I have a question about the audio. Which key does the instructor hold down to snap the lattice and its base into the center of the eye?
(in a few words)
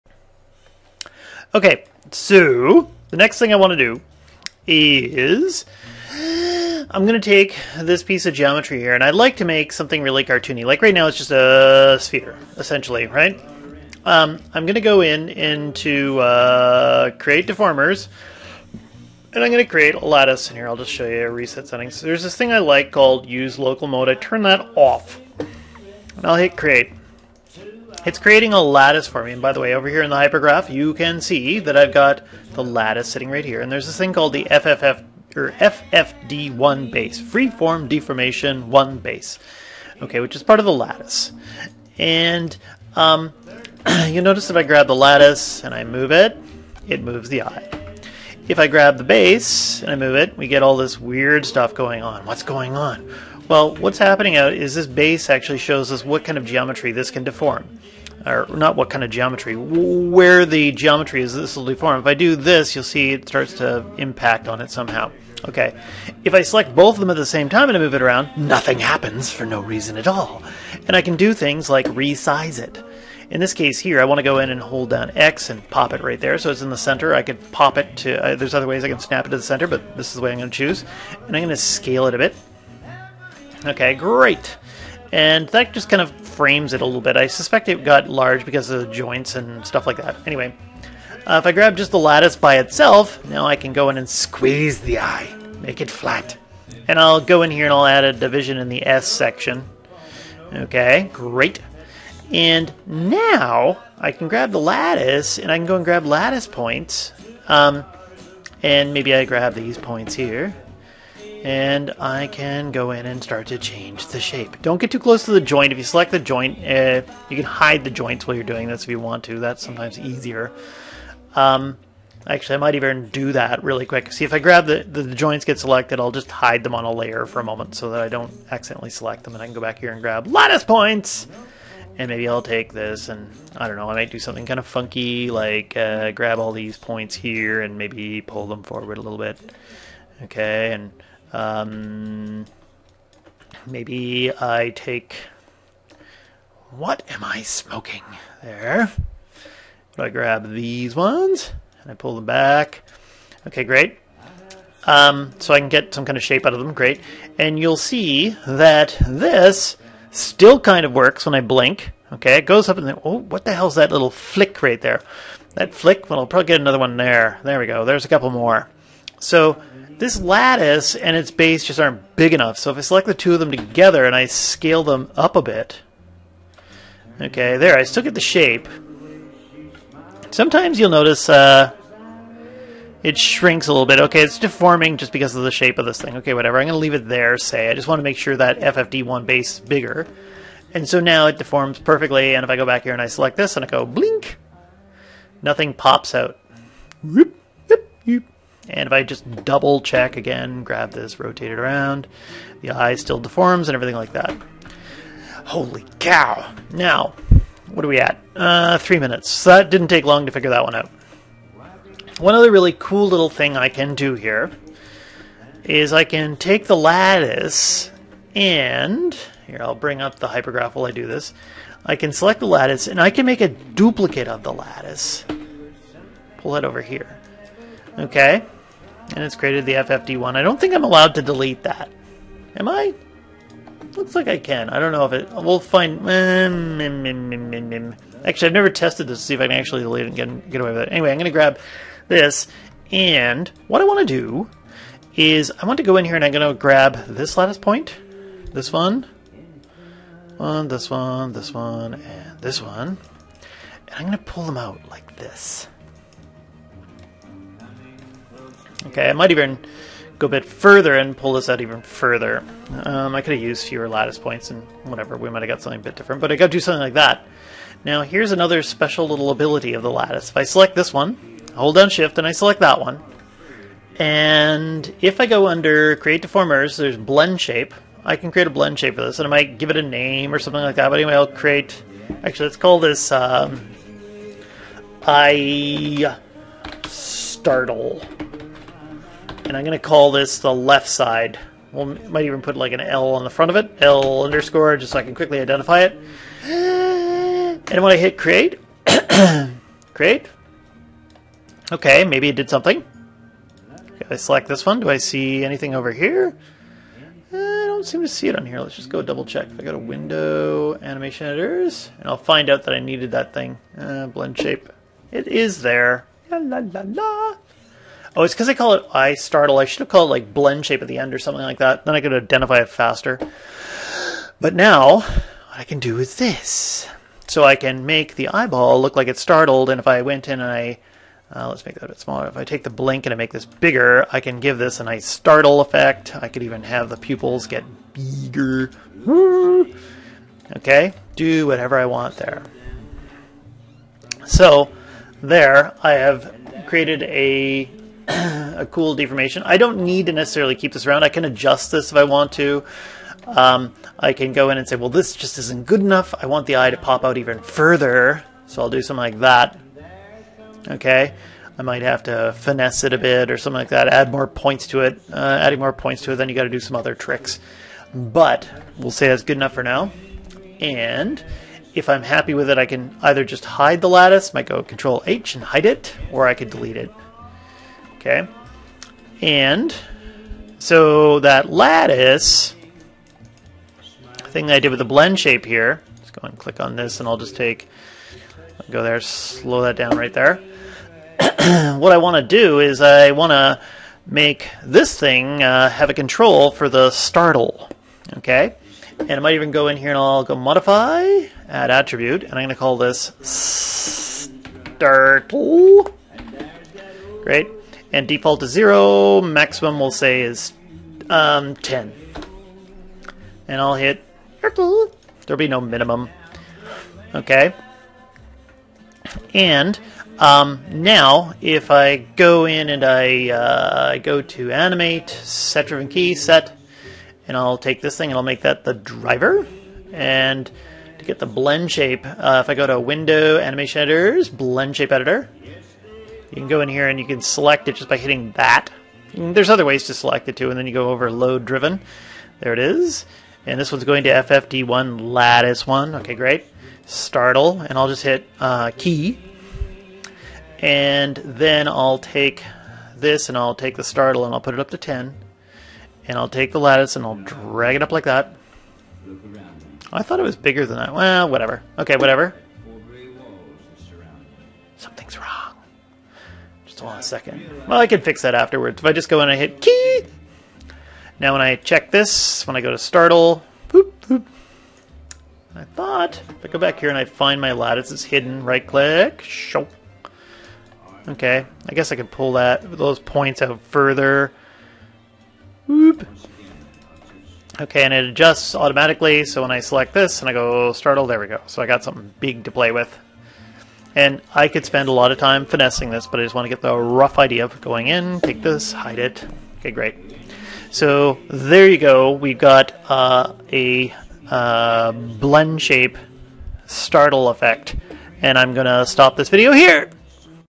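X.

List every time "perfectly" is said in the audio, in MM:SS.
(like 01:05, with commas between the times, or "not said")
03:11.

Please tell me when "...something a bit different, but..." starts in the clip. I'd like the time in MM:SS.
04:25.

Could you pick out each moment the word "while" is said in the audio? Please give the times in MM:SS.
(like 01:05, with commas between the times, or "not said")
01:58, 03:40.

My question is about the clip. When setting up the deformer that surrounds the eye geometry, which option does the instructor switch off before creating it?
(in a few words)
Use Local Mode.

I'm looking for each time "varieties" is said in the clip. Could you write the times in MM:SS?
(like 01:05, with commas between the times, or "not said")
not said.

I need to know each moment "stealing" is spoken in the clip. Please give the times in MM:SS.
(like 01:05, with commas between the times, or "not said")
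not said.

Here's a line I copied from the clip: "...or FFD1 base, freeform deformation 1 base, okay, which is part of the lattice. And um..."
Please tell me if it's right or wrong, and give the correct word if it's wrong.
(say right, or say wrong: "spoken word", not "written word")
right.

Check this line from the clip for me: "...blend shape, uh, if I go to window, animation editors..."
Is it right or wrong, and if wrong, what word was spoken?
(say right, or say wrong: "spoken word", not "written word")
right.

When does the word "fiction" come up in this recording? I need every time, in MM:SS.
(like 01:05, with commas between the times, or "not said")
not said.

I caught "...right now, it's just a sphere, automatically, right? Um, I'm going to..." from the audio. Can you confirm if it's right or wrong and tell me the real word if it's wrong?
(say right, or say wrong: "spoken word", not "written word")
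wrong: "essentially", not "automatically".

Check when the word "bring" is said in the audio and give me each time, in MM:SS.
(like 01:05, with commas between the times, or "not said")
03:39.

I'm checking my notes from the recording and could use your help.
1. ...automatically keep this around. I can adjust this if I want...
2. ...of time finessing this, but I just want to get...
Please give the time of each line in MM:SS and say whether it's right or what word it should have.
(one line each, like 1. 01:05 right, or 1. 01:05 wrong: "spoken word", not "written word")
1. 05:50 wrong: "necessarily", not "automatically"
2. 08:15 right.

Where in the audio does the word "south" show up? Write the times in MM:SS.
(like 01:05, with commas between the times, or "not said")
not said.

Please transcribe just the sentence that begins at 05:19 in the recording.
I should have called it like blend shape at the end or something like that.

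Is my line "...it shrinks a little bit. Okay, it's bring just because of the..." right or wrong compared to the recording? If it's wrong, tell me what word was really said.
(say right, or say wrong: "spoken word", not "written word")
wrong: "deforming", not "bring".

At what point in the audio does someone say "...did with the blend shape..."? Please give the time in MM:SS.
06:24.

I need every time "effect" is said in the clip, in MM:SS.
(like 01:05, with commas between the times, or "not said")
05:35, 08:27.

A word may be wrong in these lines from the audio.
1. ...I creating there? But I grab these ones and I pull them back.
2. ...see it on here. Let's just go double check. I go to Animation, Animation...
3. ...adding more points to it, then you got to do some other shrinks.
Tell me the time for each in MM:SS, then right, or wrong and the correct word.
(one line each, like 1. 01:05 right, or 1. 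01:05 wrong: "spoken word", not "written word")
1. 02:27 wrong: "smoking", not "creating"
2. 05:08 wrong: "Window", not "Animation"
3. 06:05 wrong: "tricks", not "shrinks".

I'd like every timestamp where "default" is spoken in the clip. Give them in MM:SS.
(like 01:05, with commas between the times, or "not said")
06:48.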